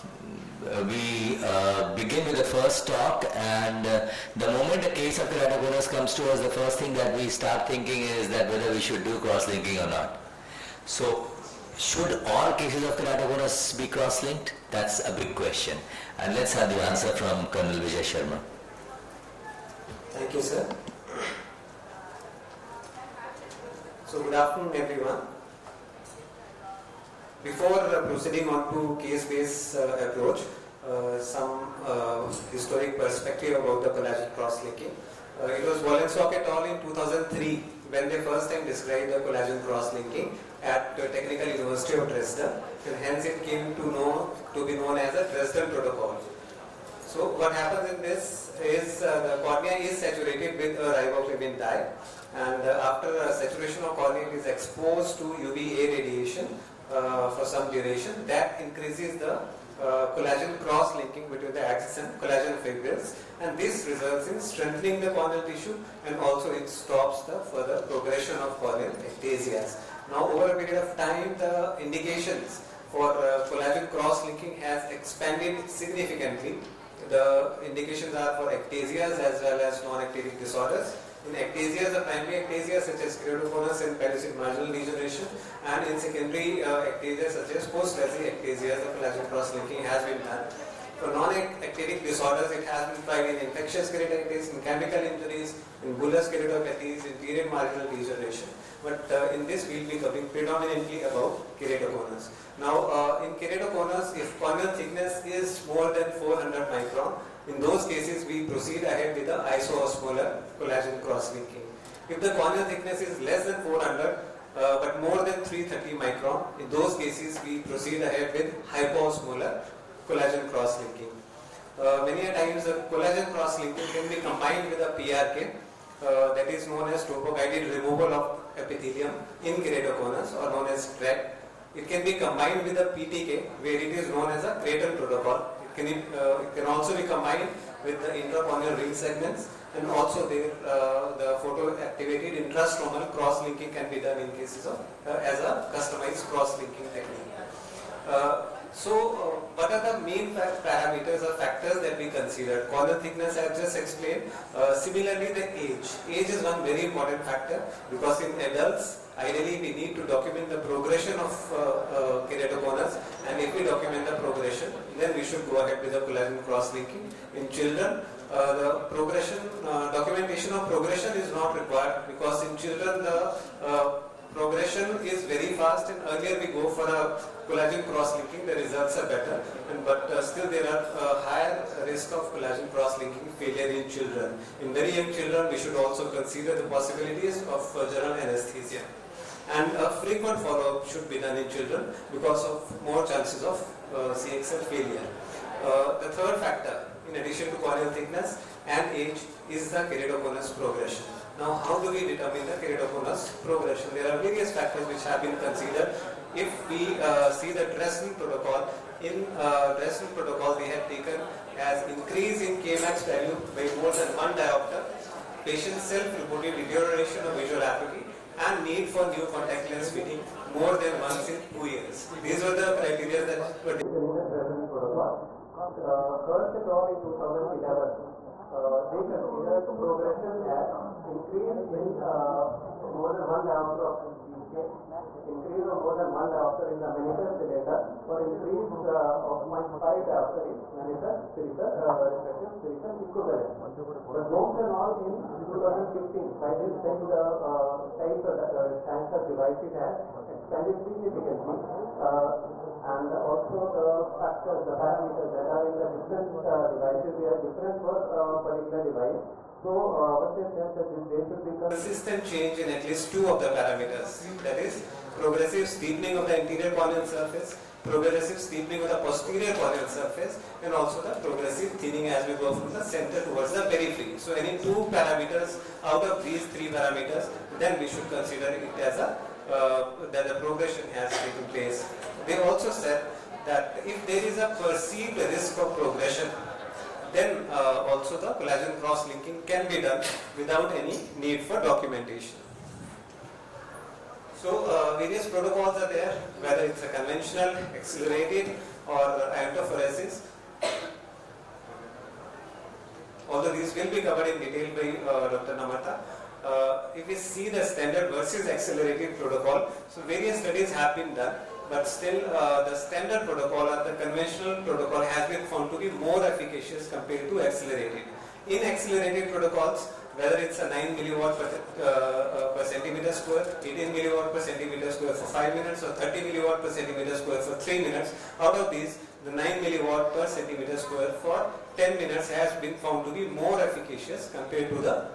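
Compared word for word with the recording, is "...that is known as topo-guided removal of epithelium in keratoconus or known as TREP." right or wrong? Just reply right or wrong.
right.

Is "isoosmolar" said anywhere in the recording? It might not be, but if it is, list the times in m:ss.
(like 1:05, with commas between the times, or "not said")
1:49.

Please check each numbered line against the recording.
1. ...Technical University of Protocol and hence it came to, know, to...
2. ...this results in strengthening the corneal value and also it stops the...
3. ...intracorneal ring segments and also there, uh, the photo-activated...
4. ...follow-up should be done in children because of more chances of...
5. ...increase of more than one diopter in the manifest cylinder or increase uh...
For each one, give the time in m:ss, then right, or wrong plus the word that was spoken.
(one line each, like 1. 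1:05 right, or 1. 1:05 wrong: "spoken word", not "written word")
1. 0:41 wrong: "Dresden", not "Protocol"
2. 1:03 wrong: "tissue", not "value"
3. 2:18 right
4. 3:10 right
5. 3:55 right.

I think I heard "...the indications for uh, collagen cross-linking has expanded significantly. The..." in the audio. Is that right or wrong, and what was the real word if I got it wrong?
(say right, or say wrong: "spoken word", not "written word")
right.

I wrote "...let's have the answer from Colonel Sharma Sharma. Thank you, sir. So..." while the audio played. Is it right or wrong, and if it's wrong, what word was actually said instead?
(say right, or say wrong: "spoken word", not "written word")
wrong: "Vijay", not "Sharma".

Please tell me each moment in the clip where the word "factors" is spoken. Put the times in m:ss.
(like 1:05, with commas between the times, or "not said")
2:31, 2:37, 3:16, 3:24, 4:14.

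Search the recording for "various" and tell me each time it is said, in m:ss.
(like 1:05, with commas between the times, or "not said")
3:24, 4:54, 5:10.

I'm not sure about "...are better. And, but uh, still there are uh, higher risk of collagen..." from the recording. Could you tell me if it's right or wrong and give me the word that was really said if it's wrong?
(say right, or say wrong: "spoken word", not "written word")
right.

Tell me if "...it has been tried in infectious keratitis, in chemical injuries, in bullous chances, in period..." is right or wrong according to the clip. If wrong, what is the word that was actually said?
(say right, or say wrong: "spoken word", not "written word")
wrong: "keratopathies", not "chances".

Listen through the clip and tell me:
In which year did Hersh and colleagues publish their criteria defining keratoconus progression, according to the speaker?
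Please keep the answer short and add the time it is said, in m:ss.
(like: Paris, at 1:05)
2011, at 3:47.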